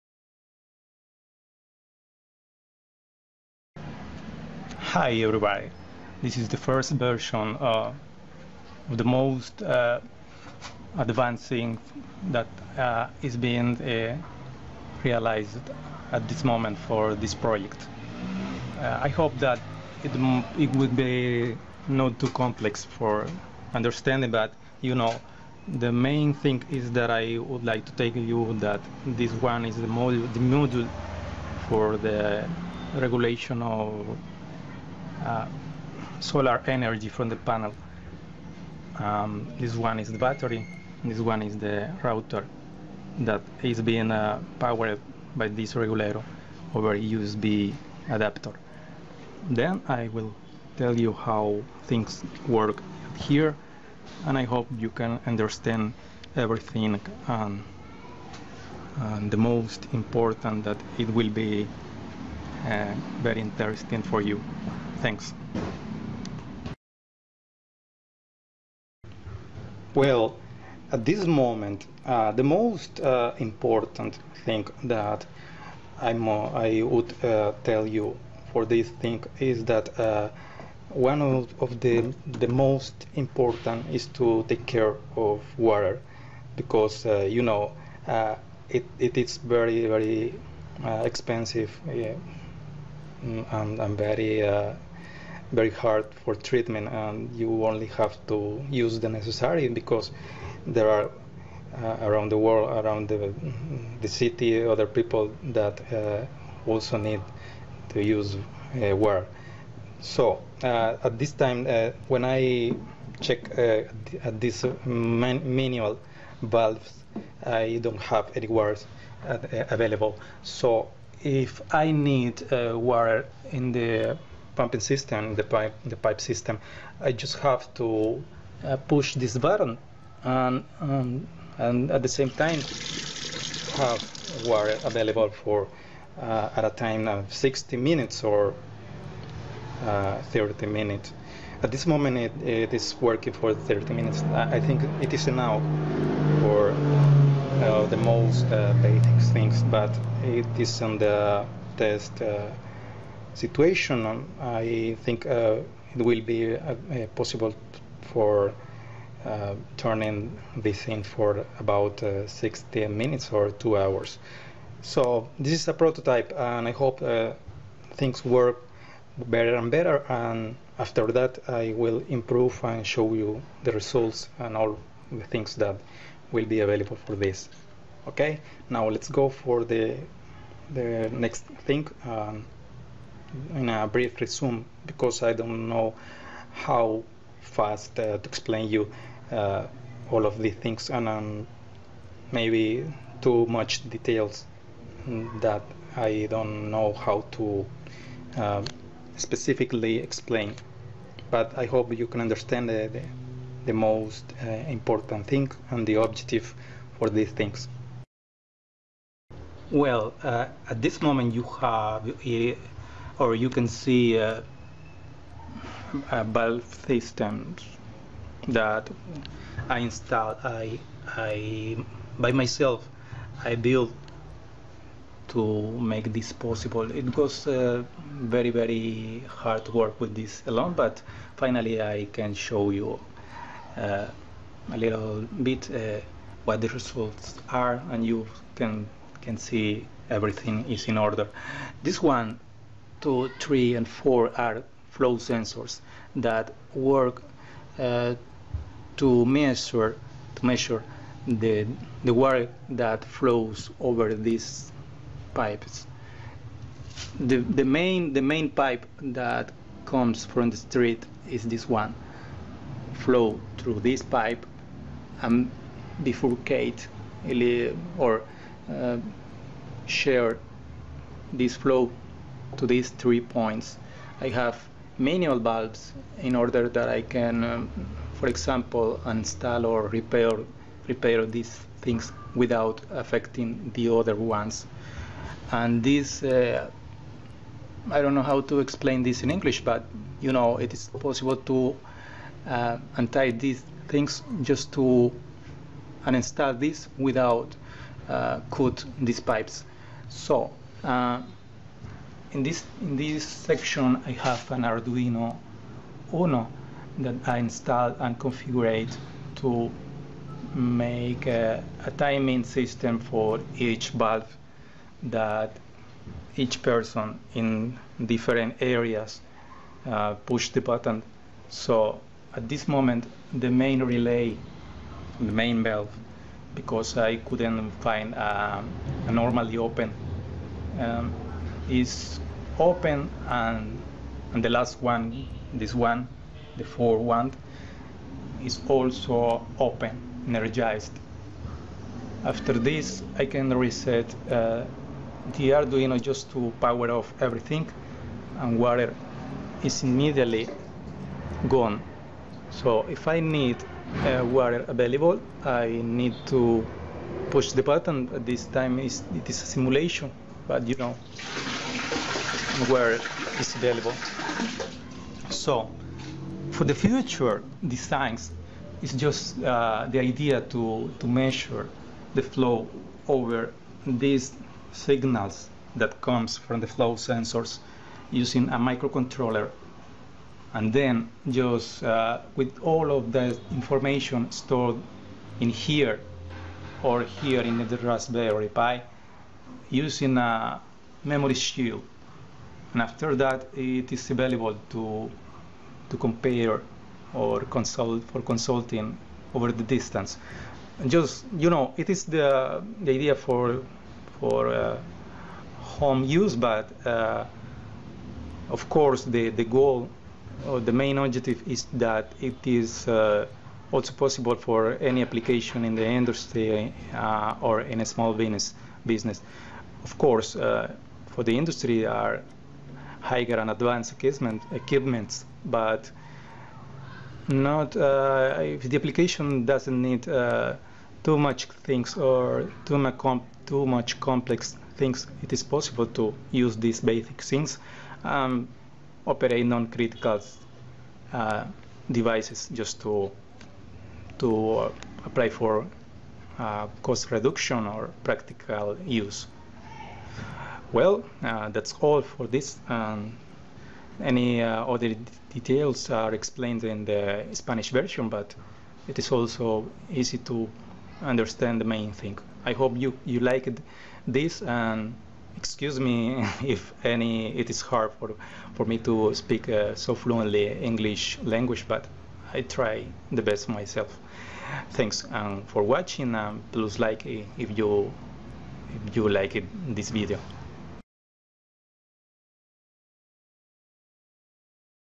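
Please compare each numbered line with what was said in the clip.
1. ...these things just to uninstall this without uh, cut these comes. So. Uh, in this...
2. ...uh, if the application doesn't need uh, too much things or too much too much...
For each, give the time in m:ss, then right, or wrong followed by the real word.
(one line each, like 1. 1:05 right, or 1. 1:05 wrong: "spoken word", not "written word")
1. 4:53 wrong: "pipes", not "comes"
2. 7:07 right.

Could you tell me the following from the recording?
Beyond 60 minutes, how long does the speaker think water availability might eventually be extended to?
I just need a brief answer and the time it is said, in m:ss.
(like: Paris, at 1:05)
two hours, at 2:43.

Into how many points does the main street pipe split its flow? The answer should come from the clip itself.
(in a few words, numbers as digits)
3.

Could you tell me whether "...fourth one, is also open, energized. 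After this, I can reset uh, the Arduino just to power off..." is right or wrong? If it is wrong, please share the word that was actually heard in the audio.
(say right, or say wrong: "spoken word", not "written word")
right.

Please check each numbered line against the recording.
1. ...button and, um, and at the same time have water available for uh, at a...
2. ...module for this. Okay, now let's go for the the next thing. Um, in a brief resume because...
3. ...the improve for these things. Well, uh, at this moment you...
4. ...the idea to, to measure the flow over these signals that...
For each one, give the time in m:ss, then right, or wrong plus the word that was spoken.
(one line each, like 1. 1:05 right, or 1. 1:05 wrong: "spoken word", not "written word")
1. 2:09 right
2. 2:56 wrong: "available", not "module"
3. 3:25 wrong: "objective", not "improve"
4. 6:09 right.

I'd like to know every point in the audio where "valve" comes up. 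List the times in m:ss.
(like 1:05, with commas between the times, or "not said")
1:56, 3:36, 4:35, 5:13, 5:25.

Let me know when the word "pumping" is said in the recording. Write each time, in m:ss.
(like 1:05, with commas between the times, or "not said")
2:04.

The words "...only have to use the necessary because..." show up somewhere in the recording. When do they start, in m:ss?
1:37.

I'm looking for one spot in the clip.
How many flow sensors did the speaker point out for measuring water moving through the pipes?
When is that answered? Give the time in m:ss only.
4:03.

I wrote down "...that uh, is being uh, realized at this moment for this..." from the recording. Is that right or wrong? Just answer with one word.
right.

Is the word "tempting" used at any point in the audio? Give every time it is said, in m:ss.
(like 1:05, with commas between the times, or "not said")
not said.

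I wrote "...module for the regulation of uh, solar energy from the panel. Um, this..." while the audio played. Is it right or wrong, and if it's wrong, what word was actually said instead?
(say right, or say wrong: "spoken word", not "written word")
right.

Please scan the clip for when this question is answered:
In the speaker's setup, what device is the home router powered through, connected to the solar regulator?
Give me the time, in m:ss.
0:46.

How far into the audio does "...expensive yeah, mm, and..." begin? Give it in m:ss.
1:30.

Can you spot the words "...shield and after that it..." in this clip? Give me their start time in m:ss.
6:31.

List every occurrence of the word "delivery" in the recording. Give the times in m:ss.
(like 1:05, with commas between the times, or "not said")
not said.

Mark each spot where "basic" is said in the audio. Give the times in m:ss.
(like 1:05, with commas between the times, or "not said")
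2:28, 7:16.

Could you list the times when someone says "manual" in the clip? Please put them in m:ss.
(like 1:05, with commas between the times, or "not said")
1:55, 4:34.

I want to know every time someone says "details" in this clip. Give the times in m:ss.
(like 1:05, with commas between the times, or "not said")
3:13, 7:35.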